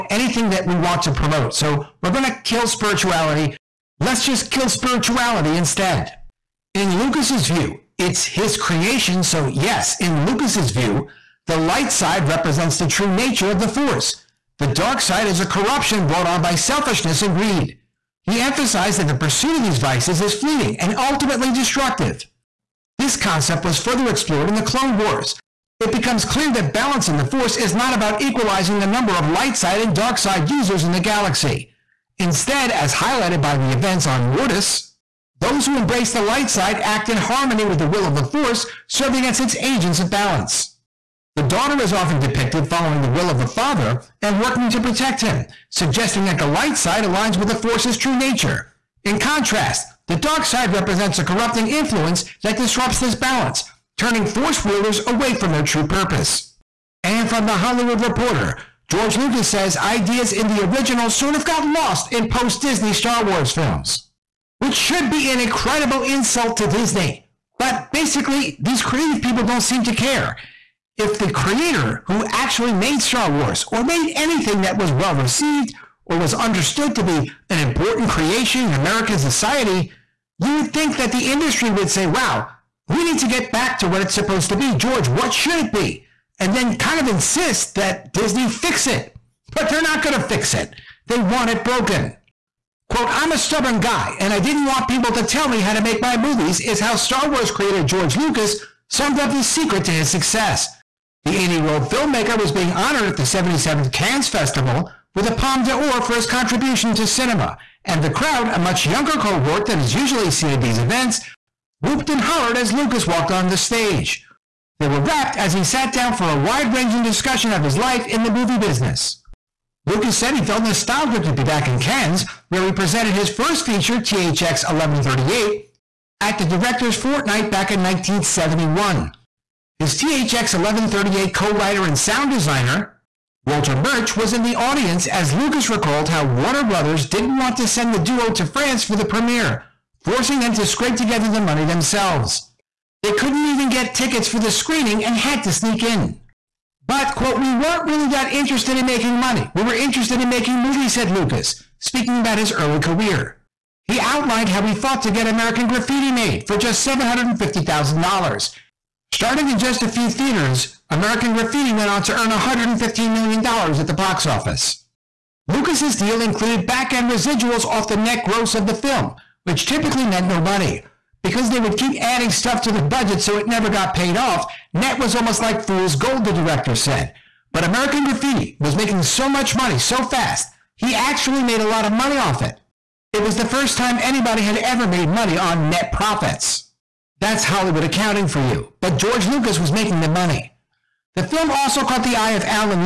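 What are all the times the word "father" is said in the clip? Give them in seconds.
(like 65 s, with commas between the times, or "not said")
43 s.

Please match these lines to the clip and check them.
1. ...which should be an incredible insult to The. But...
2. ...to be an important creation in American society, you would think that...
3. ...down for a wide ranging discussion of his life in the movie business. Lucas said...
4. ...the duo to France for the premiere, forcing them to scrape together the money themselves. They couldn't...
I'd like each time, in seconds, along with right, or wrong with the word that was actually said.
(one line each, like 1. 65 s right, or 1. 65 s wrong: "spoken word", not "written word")
1. 64 s wrong: "Disney", not "The"
2. 76 s right
3. 115 s right
4. 137 s right.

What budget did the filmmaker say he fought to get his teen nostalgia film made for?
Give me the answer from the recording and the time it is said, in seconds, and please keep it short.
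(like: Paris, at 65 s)
$750,000, at 156 s.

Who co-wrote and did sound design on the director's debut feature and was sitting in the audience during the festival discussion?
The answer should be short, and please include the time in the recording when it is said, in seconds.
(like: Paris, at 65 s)
Walter Murch, at 133 s.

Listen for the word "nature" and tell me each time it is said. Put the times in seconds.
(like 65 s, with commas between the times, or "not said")
13 s, 48 s.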